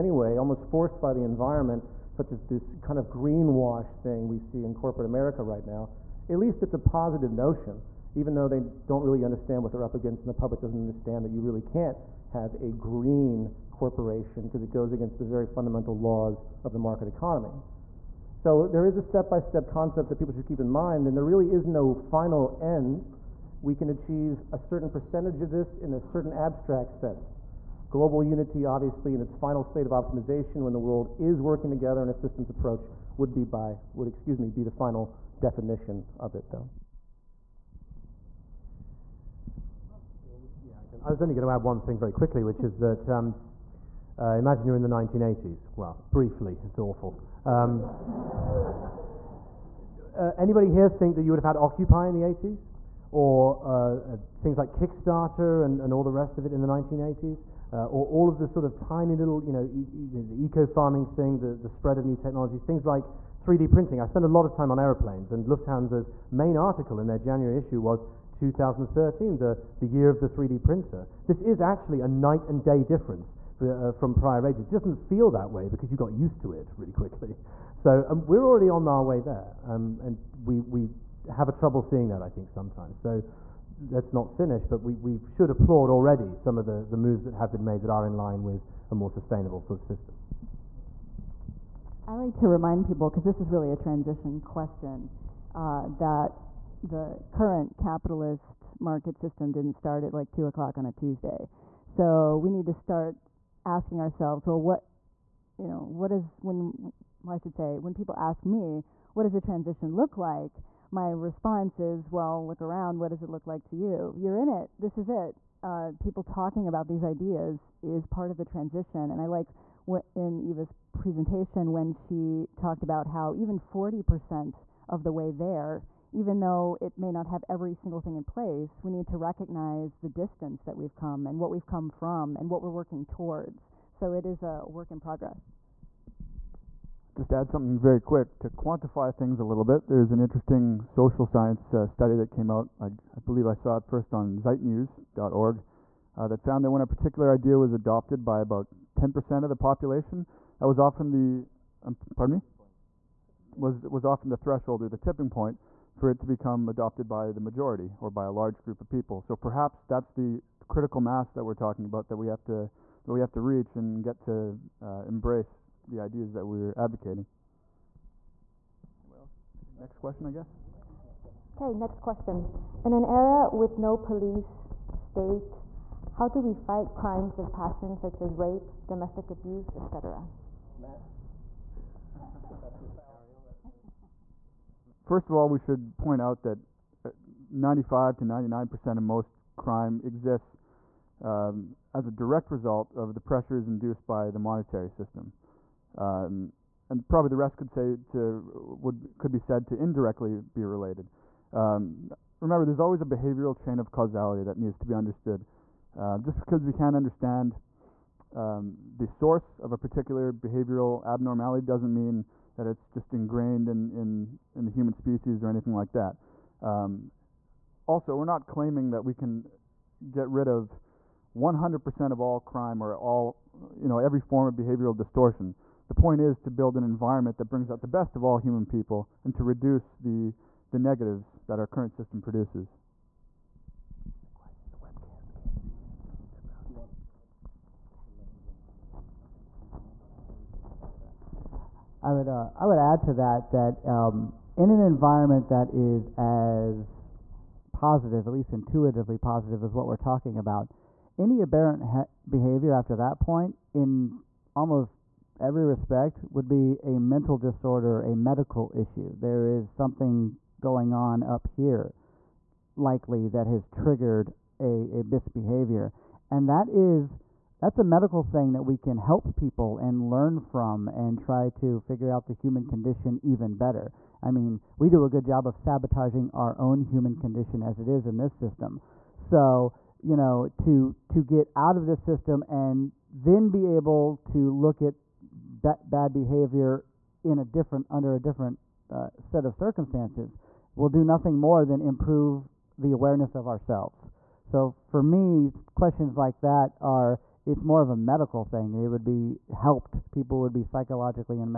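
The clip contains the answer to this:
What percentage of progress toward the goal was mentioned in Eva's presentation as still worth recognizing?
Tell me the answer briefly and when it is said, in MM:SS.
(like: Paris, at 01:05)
40%, at 02:03.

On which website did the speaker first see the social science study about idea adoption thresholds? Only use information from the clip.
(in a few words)
zeitnews.org.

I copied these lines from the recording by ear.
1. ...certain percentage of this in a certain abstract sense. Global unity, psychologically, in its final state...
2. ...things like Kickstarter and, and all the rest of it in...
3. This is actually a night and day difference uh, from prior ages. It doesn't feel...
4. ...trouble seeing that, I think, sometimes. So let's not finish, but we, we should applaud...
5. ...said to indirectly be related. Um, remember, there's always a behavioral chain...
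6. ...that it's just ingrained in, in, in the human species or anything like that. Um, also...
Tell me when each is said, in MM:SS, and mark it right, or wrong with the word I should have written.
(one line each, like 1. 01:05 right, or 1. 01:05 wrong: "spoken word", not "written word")
1. 00:24 wrong: "obviously", not "psychologically"
2. 00:54 right
3. 01:11 right
4. 01:21 right
5. 03:19 right
6. 03:32 right.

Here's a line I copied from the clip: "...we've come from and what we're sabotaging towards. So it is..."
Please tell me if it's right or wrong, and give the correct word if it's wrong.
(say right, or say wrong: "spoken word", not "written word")
wrong: "working", not "sabotaging".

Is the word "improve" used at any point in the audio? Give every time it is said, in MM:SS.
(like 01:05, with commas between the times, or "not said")
04:51.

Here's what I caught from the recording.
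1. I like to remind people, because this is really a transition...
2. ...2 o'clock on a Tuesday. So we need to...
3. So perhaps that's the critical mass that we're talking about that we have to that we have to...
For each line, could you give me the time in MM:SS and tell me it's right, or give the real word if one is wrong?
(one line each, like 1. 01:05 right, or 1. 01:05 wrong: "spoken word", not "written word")
1. 01:32 right
2. 01:40 right
3. 02:39 right.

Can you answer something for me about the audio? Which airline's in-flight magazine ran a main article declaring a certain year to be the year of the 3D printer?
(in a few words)
Lufthansa.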